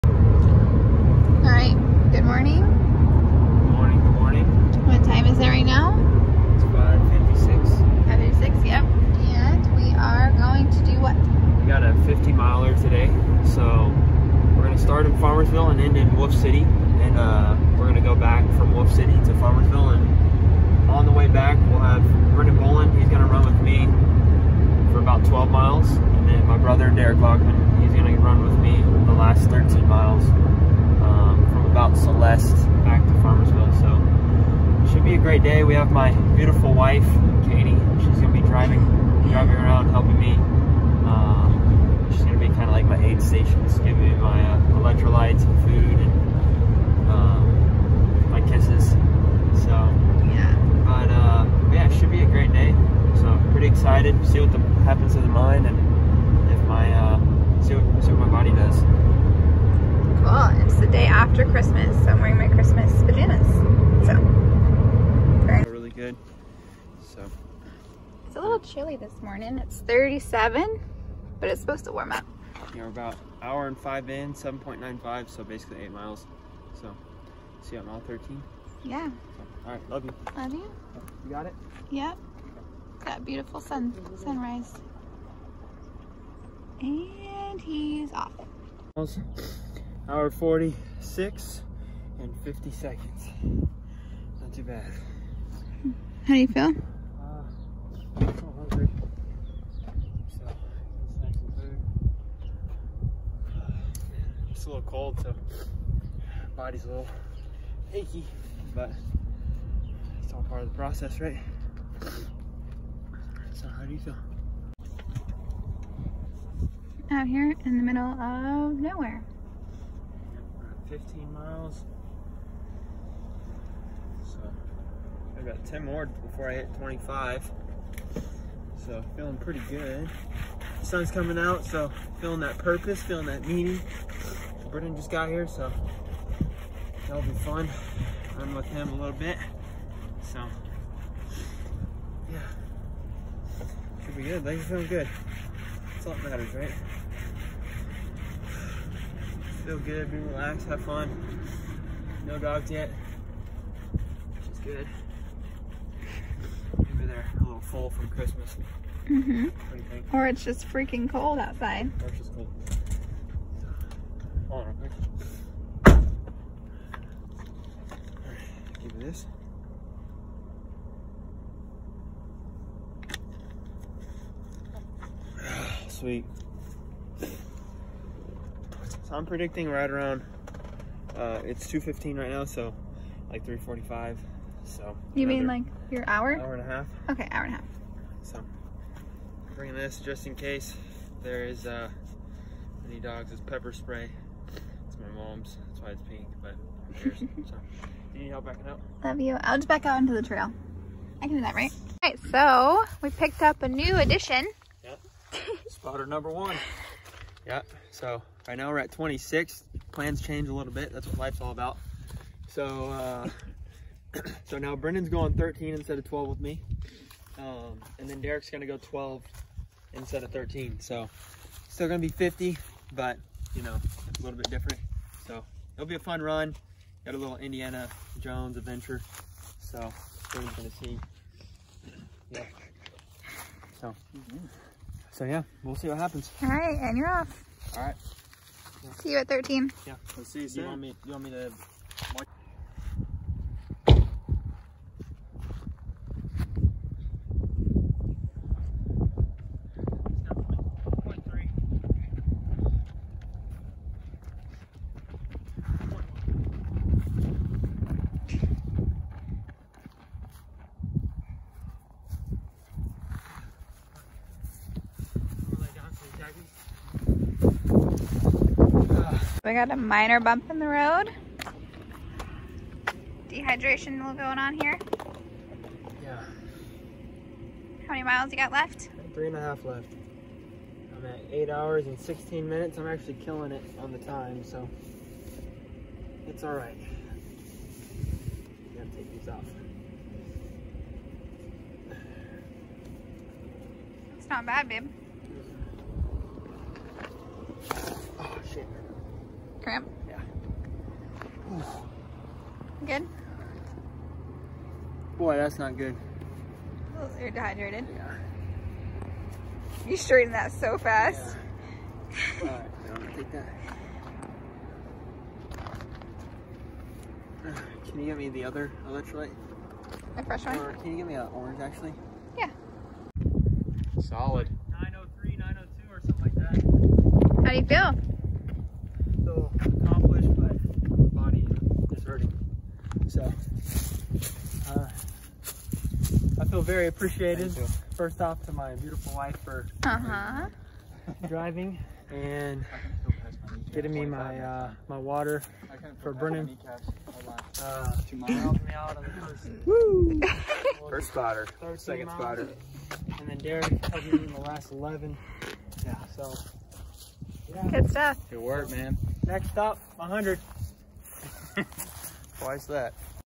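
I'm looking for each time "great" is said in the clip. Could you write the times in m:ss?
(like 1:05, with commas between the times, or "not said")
0:35, 0:52.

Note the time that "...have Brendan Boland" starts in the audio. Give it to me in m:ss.
0:21.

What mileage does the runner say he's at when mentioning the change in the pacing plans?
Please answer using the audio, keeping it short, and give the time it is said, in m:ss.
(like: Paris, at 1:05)
26, at 3:28.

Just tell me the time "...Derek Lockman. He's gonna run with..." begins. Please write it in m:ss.
0:26.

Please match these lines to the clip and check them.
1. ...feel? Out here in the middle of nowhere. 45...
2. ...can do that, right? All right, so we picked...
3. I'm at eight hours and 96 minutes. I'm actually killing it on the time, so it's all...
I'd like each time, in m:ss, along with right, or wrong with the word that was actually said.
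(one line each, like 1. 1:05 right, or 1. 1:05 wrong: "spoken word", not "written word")
1. 1:53 wrong: "15", not "45"
2. 3:21 right
3. 4:40 wrong: "16", not "96".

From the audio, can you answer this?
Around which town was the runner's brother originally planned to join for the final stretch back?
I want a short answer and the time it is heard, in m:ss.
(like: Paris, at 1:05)
Celeste, at 0:31.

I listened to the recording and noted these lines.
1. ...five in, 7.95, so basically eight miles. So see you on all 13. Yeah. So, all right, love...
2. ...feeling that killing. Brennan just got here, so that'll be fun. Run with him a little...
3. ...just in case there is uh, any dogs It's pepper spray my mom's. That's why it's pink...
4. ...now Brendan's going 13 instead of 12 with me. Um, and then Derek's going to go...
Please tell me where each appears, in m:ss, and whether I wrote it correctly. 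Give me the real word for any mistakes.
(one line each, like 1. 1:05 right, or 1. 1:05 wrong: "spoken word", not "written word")
1. 1:13 right
2. 2:13 wrong: "meaning", not "killing"
3. 3:09 right
4. 3:34 right.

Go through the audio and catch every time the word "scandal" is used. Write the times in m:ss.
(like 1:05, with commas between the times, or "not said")
not said.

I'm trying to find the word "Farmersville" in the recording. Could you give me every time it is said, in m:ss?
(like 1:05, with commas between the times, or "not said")
0:15, 0:19, 0:33.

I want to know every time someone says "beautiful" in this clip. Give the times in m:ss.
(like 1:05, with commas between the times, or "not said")
0:36, 1:23, 5:38.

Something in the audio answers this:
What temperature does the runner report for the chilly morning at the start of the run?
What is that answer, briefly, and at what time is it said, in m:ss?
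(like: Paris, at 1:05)
37, at 1:09.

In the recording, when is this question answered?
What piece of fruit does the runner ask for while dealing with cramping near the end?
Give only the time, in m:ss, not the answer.
5:21.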